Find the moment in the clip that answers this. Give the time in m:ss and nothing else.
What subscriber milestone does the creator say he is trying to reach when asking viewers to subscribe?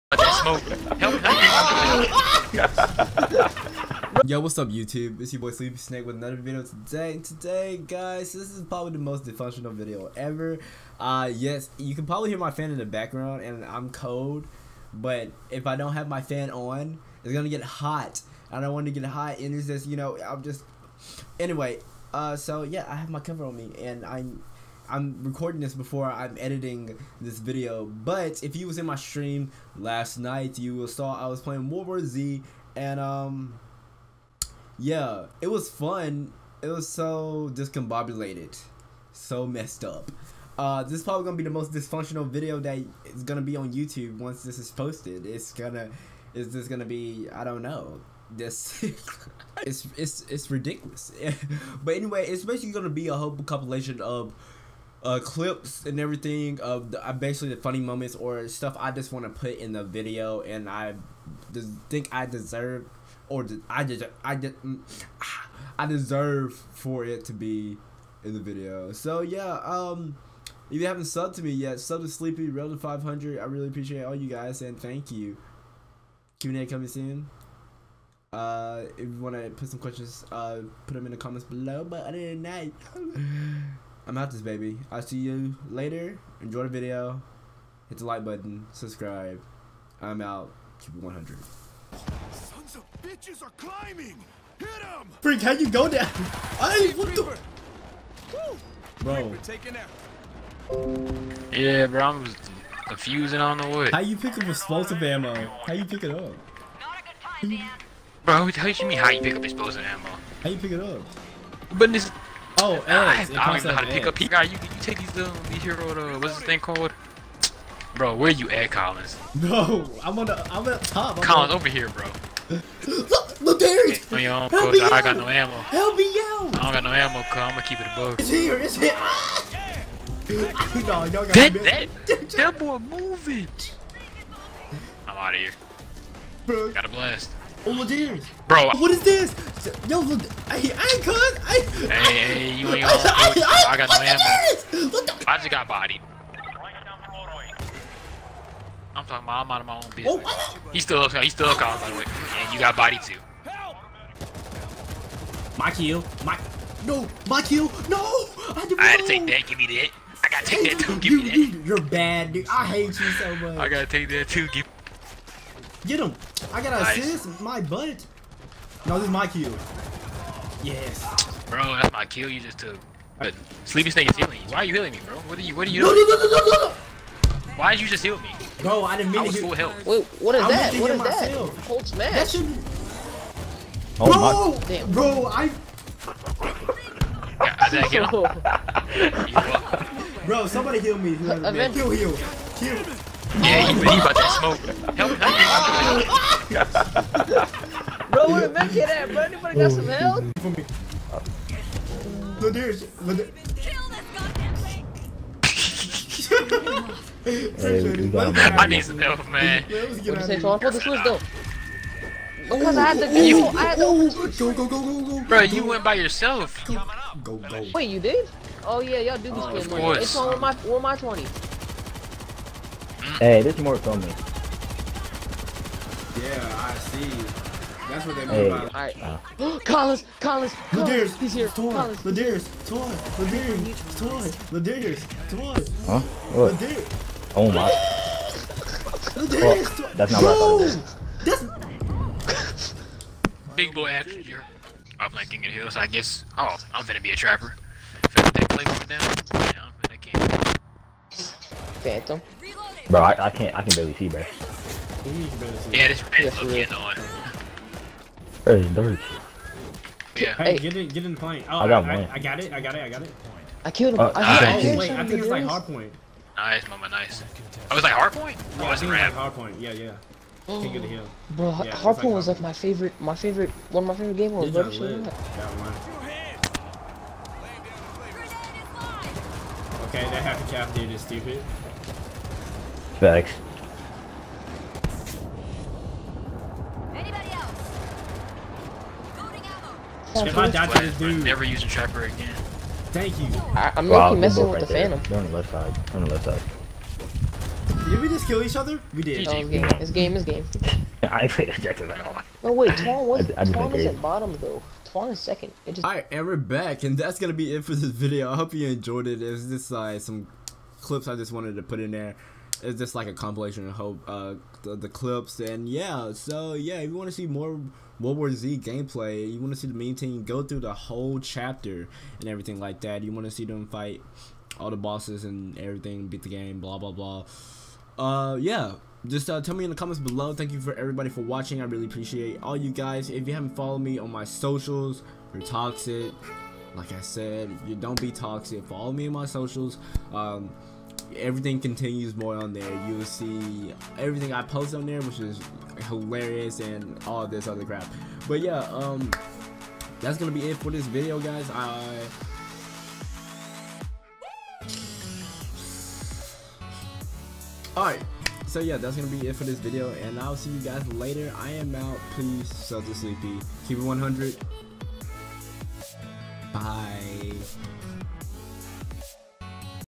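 1:12.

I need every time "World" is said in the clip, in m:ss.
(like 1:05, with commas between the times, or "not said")
0:31, 5:17.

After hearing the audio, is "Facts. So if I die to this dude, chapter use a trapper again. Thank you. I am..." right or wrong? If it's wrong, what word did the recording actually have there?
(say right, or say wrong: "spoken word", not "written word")
wrong: "never", not "chapter".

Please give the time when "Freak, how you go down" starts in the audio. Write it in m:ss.
1:35.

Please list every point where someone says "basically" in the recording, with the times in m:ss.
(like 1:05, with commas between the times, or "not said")
0:52, 0:57.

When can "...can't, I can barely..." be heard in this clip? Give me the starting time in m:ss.
4:13.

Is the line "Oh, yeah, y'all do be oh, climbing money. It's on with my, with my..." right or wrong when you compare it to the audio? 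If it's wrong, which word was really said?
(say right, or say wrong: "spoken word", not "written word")
wrong: "spending", not "climbing".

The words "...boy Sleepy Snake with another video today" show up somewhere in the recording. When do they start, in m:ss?
0:05.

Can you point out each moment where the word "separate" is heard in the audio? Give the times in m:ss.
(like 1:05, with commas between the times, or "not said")
not said.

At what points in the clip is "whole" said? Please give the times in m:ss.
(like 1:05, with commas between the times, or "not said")
0:53, 5:20.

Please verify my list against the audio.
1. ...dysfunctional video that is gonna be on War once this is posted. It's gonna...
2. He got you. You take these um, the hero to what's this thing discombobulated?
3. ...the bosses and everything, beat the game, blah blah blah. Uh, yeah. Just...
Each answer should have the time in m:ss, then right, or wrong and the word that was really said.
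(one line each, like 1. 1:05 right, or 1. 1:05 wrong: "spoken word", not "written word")
1. 0:41 wrong: "YouTube", not "War"
2. 1:54 wrong: "called", not "discombobulated"
3. 5:24 right.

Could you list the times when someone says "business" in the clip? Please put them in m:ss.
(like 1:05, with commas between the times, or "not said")
2:29.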